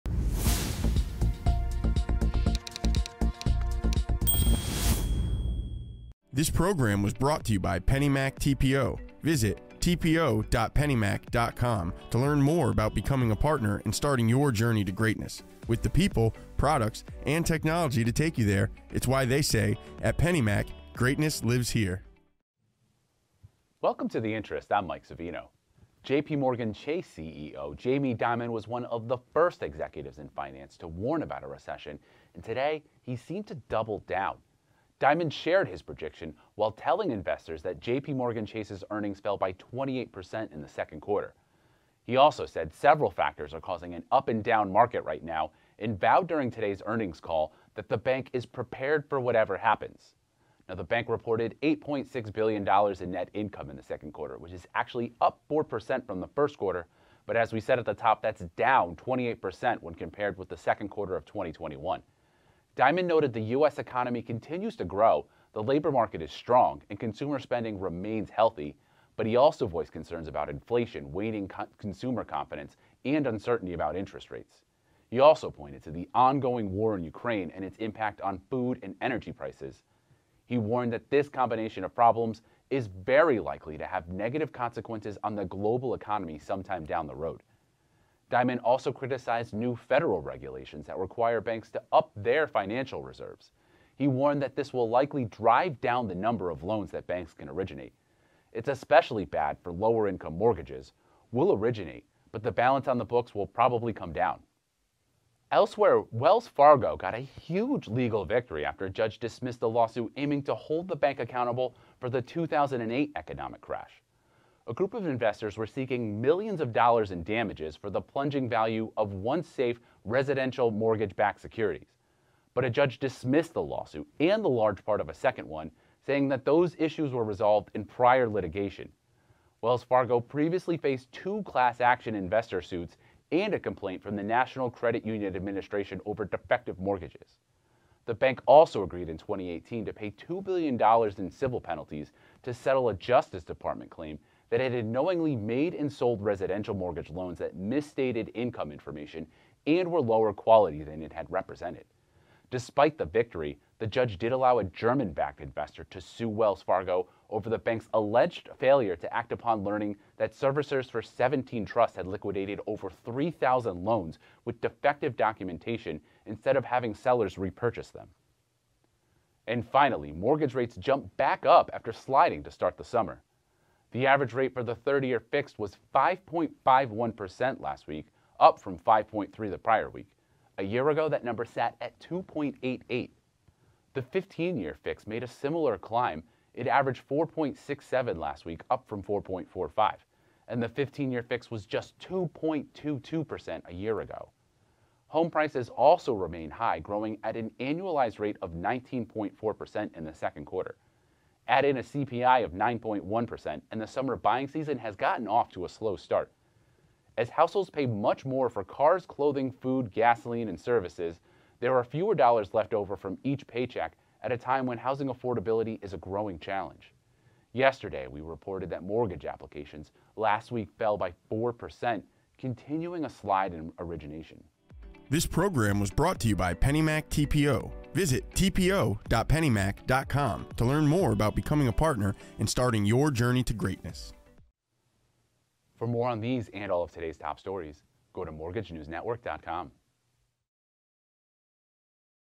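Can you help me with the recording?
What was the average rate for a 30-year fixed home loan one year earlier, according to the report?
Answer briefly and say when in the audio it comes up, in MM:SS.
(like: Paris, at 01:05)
2.88%, at 03:01.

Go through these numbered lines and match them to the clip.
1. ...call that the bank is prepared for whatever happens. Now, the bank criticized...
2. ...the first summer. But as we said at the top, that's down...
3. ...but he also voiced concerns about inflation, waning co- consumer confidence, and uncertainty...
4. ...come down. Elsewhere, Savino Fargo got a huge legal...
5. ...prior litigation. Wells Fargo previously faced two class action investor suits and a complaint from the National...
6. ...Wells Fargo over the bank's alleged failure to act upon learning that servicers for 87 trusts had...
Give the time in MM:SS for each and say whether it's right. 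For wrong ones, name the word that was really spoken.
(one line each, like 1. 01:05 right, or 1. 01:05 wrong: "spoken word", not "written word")
1. 00:47 wrong: "reported", not "criticized"
2. 00:56 wrong: "quarter", not "summer"
3. 01:09 right
4. 01:43 wrong: "Wells", not "Savino"
5. 02:07 right
6. 02:36 wrong: "17", not "87".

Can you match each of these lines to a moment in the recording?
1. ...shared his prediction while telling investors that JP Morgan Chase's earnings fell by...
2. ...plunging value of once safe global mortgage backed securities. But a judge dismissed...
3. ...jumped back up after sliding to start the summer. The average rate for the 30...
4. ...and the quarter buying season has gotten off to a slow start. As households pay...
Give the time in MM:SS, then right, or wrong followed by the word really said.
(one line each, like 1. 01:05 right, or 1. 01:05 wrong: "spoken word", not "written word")
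1. 00:35 right
2. 01:57 wrong: "residential", not "global"
3. 02:50 right
4. 03:23 wrong: "summer", not "quarter".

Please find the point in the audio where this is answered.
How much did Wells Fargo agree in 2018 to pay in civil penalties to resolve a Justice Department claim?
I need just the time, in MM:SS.
02:20.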